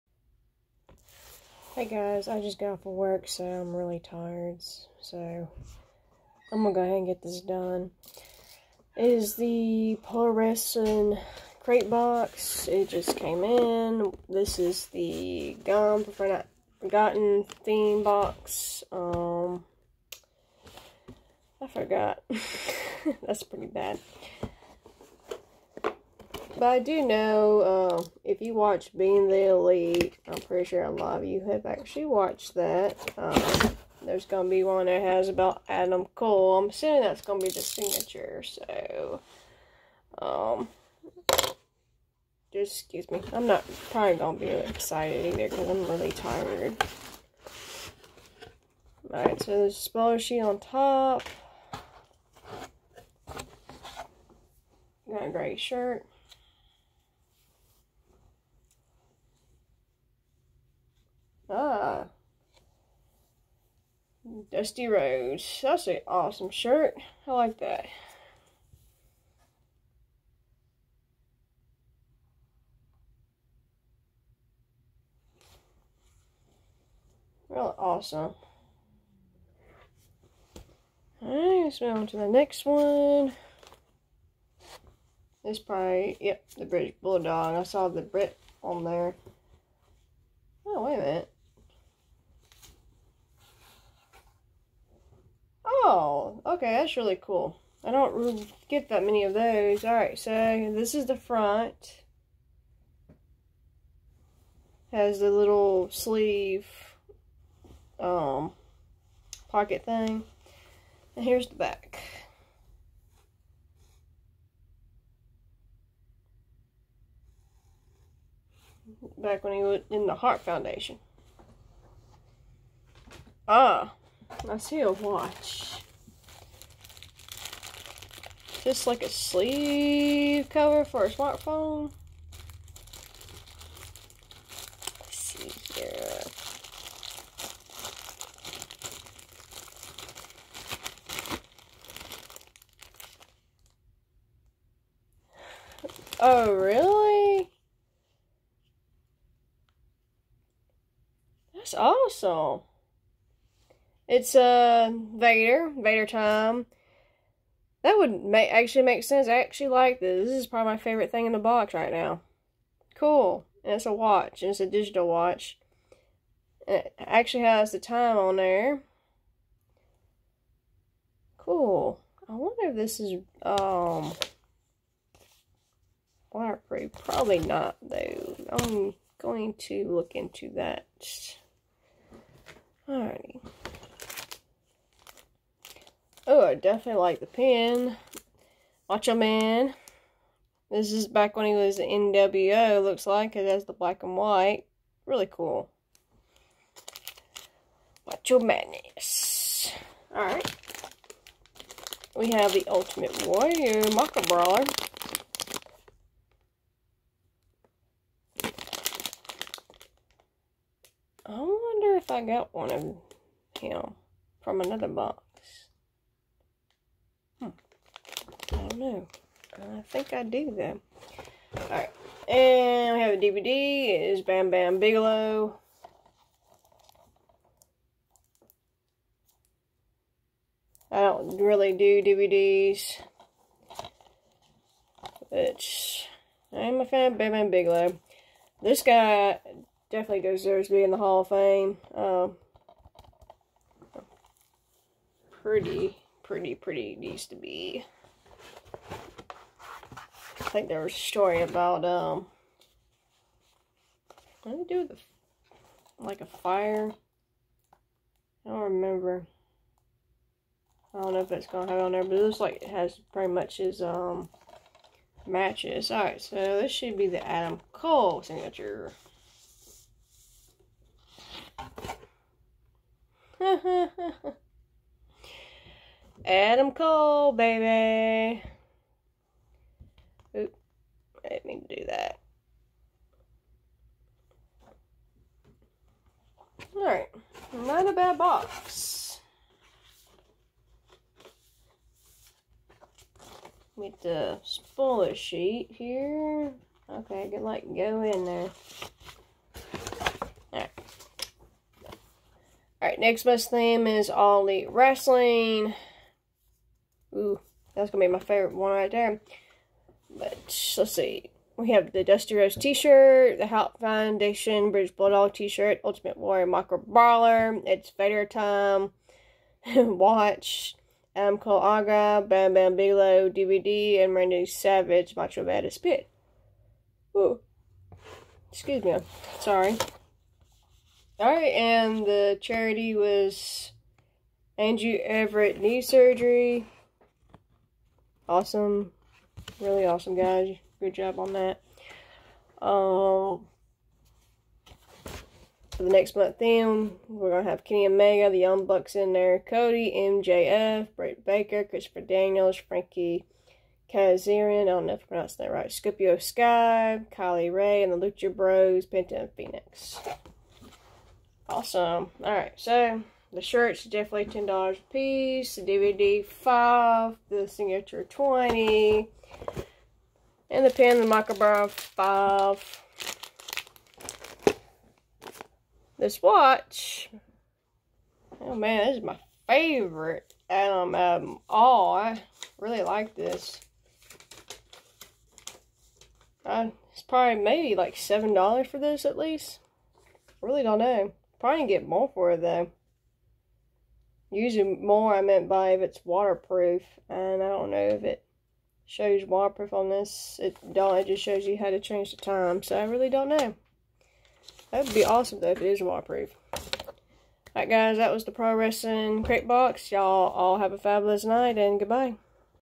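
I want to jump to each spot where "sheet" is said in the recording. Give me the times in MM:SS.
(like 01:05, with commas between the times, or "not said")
00:50, 04:55.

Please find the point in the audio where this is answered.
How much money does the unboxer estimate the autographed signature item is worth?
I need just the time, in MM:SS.
06:08.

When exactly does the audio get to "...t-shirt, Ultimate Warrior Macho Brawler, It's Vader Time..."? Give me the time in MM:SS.
05:15.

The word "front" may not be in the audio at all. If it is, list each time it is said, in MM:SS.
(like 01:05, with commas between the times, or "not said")
01:41.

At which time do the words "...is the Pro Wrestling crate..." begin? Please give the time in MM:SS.
00:09.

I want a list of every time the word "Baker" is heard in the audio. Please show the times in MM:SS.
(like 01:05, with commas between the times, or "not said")
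05:51.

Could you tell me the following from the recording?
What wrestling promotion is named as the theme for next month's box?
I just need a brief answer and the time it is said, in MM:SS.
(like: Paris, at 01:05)
All Elite Wrestling, at 05:04.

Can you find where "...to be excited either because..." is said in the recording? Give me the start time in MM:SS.
00:44.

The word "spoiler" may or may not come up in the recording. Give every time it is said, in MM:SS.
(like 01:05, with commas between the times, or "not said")
00:49, 04:54.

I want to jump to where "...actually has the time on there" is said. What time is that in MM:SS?
02:46.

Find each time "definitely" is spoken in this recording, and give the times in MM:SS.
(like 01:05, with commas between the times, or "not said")
03:06, 03:59, 06:03.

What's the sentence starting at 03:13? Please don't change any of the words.
It has the black and white.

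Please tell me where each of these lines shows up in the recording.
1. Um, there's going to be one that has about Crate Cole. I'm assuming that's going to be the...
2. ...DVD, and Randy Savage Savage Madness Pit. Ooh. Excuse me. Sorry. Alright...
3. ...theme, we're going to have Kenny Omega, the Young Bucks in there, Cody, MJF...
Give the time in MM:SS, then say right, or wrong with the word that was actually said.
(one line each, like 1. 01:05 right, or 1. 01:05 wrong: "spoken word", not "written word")
1. 00:33 wrong: "Adam", not "Crate"
2. 05:23 wrong: "Macho", not "Savage"
3. 05:46 right.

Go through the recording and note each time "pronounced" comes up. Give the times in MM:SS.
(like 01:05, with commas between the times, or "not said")
05:55.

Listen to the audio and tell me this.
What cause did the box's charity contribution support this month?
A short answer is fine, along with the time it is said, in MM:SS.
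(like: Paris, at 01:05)
Andrew Everett Knee Surgery, at 05:34.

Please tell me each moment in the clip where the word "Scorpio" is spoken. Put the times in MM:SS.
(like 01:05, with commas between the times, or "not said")
05:55.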